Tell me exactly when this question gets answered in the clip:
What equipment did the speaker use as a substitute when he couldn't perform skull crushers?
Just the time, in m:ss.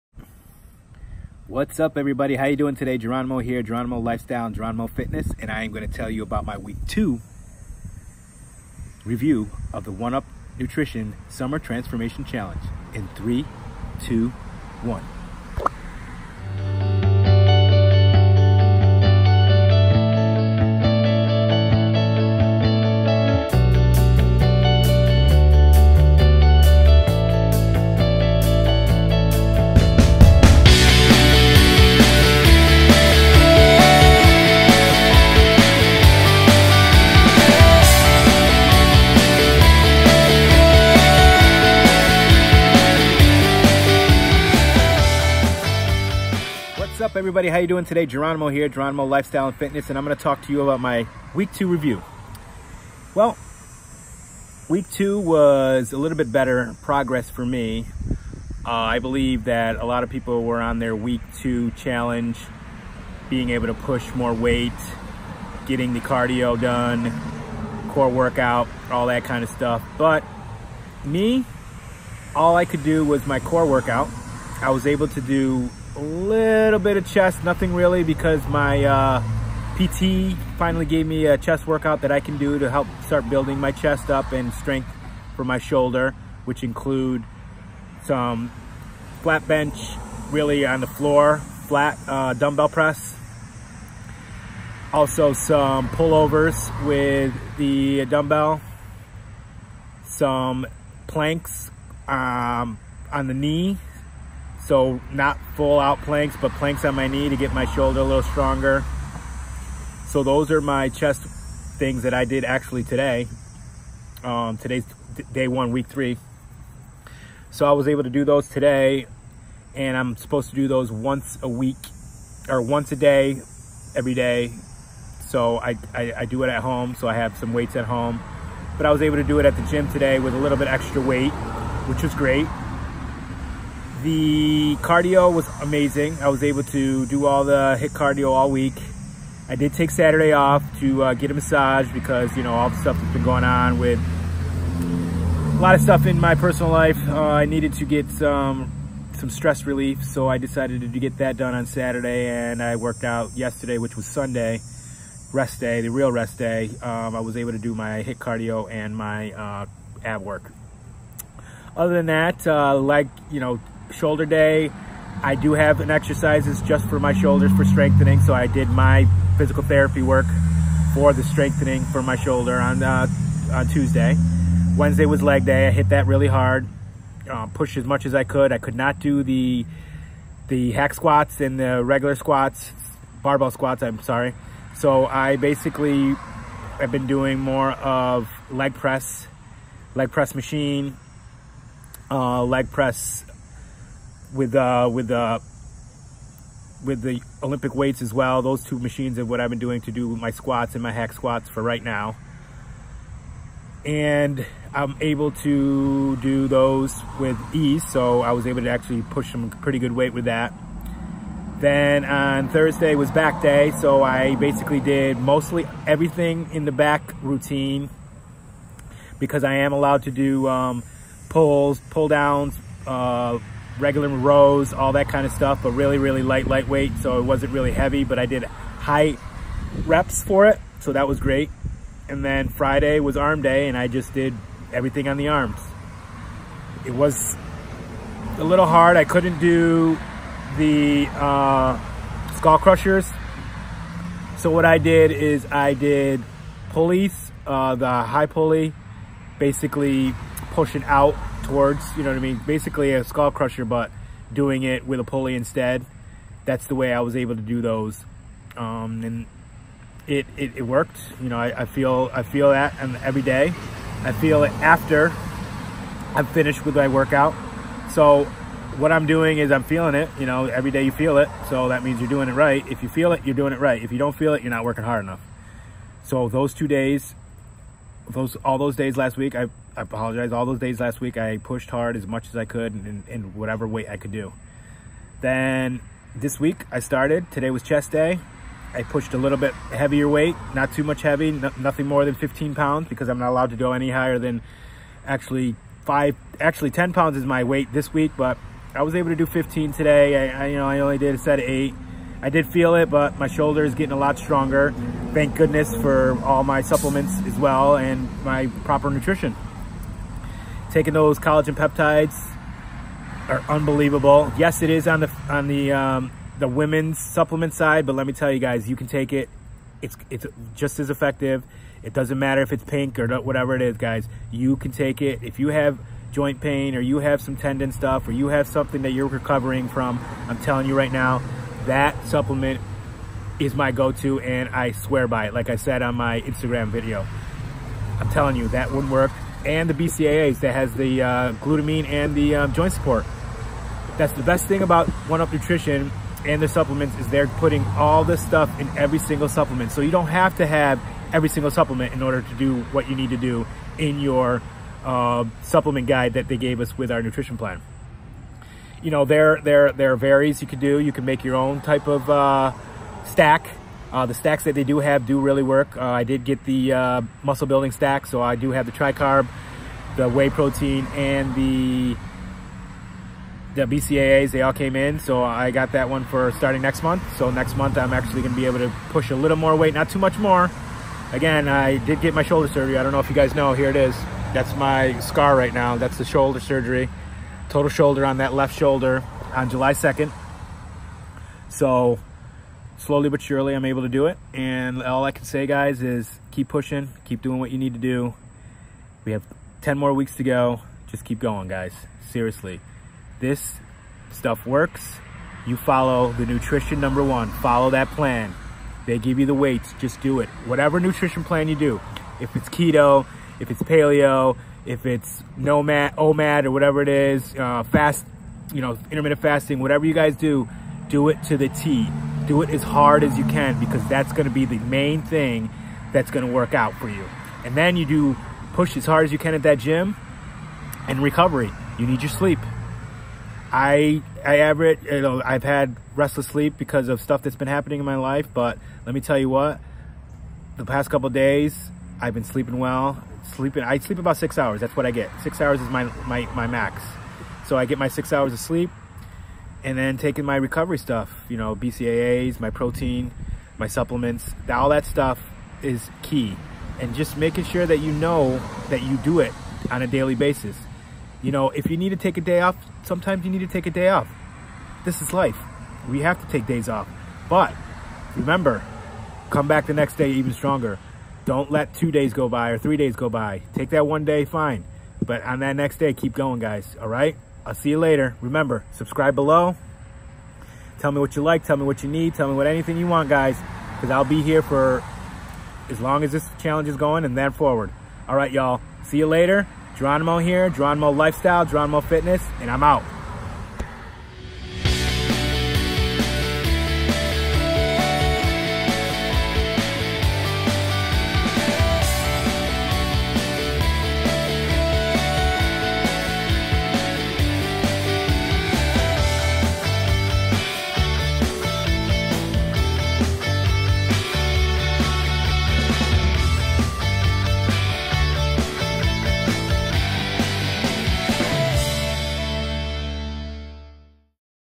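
4:06.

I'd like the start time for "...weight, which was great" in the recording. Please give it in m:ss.
2:11.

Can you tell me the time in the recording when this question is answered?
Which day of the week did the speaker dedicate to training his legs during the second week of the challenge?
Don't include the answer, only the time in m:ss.
2:54.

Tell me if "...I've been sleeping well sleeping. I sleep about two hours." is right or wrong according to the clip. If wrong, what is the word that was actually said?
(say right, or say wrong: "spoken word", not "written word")
wrong: "six", not "two".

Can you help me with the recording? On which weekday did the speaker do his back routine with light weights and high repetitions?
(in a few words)
Thursday.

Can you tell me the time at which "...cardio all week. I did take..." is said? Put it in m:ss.
2:17.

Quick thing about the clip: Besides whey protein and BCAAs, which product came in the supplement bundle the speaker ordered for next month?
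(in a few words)
tricarb.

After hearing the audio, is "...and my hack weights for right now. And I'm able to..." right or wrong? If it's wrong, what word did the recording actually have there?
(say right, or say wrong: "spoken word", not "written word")
wrong: "squats", not "weights".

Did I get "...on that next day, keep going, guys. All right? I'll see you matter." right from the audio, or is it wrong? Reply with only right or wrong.
wrong.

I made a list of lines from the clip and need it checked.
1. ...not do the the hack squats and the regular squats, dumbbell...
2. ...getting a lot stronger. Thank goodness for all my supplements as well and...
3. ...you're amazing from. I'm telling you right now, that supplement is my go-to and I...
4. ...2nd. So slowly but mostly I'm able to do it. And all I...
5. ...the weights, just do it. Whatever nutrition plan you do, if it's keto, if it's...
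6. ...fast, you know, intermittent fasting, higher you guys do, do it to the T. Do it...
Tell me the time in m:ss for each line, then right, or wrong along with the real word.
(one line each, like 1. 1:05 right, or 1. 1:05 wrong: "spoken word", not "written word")
1. 2:58 wrong: "barbell", not "dumbbell"
2. 5:03 right
3. 5:28 wrong: "recovering", not "amazing"
4. 6:29 wrong: "surely", not "mostly"
5. 6:49 right
6. 6:57 wrong: "whatever", not "higher".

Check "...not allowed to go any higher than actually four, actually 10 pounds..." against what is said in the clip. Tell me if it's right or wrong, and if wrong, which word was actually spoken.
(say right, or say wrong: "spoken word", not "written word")
wrong: "five", not "four".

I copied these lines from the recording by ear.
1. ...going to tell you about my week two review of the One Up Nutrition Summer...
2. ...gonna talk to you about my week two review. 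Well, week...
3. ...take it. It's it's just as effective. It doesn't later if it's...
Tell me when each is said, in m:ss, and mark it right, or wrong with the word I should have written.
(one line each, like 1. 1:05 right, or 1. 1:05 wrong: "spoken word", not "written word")
1. 0:05 right
2. 0:50 right
3. 5:18 wrong: "matter", not "later".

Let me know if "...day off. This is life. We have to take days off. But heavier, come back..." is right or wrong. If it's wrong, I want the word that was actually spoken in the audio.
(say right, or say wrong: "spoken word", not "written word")
wrong: "remember", not "heavier".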